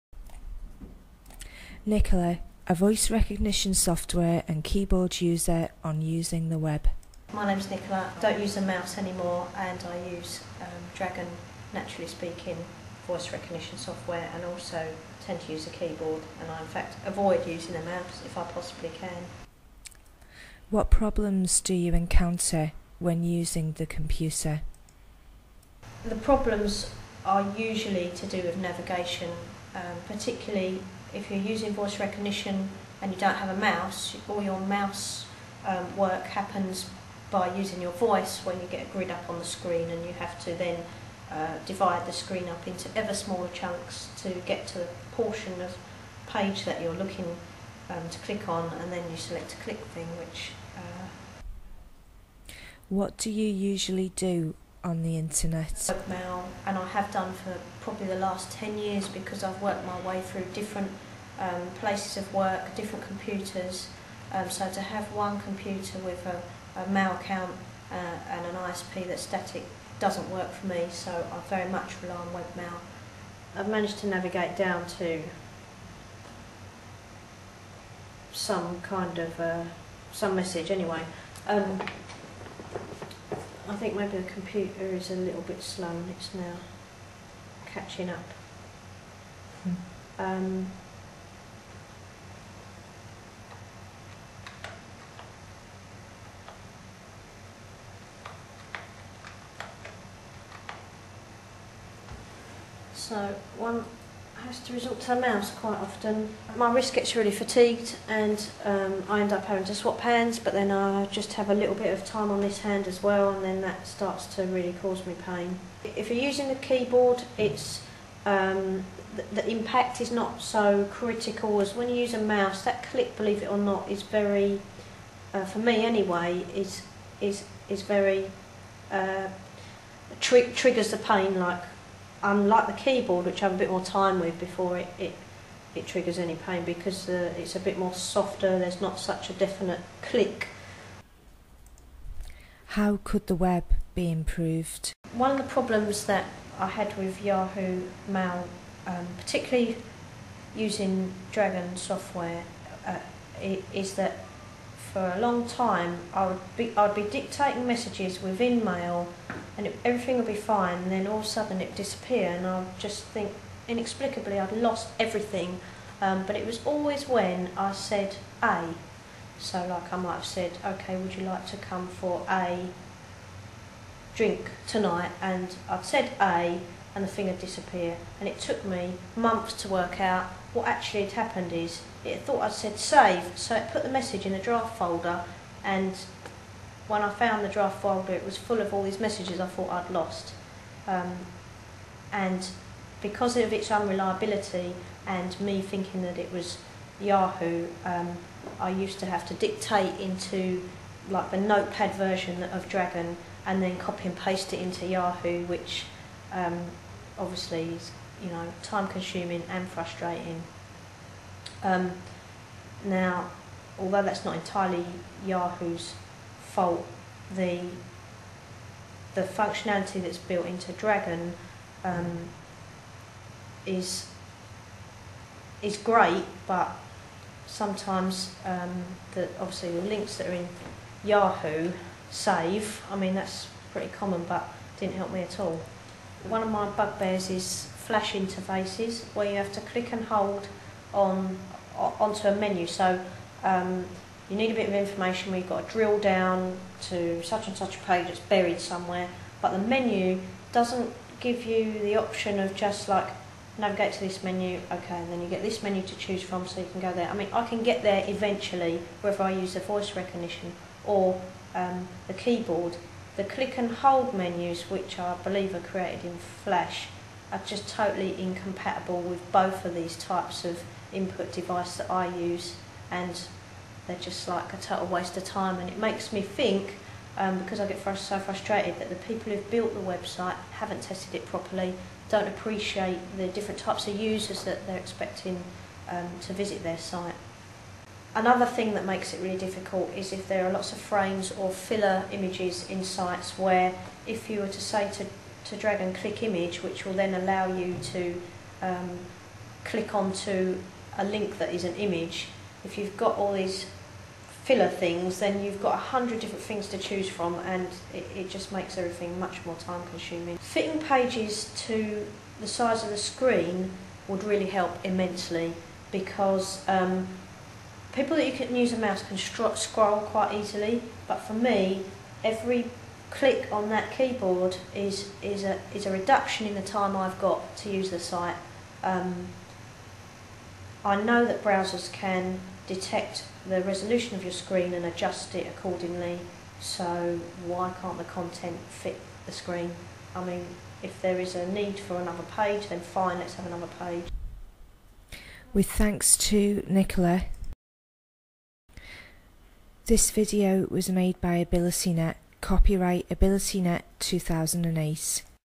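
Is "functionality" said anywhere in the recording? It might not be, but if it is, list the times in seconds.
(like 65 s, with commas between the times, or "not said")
219 s.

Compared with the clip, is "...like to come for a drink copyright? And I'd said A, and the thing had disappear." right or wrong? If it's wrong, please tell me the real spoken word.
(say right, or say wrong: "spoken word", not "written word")
wrong: "tonight", not "copyright".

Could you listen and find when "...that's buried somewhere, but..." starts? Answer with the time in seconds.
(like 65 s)
248 s.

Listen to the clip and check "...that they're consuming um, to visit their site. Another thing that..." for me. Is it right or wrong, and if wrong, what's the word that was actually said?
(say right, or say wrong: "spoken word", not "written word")
wrong: "expecting", not "consuming".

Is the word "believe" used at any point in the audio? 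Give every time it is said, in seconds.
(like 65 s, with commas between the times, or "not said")
123 s, 265 s.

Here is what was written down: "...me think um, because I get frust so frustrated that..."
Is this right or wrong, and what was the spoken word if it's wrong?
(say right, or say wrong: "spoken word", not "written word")
right.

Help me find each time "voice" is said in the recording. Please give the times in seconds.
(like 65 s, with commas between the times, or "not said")
2 s, 13 s, 31 s, 37 s, 259 s.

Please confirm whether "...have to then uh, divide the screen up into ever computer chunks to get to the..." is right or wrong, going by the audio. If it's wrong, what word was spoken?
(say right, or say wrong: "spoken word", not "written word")
wrong: "smaller", not "computer".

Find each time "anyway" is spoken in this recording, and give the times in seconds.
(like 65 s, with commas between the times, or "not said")
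80 s, 125 s.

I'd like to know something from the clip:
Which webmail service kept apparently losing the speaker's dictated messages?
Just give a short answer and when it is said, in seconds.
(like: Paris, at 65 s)
Yahoo Mail, at 147 s.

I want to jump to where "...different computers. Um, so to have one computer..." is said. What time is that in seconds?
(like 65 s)
62 s.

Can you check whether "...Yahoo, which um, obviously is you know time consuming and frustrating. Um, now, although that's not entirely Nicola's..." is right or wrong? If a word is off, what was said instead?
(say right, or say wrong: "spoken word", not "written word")
wrong: "Yahoo", not "Nicola".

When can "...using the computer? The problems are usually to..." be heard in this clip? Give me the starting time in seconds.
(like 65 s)
23 s.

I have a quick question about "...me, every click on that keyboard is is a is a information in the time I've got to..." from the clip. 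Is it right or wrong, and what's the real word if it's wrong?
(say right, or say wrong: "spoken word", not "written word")
wrong: "reduction", not "information".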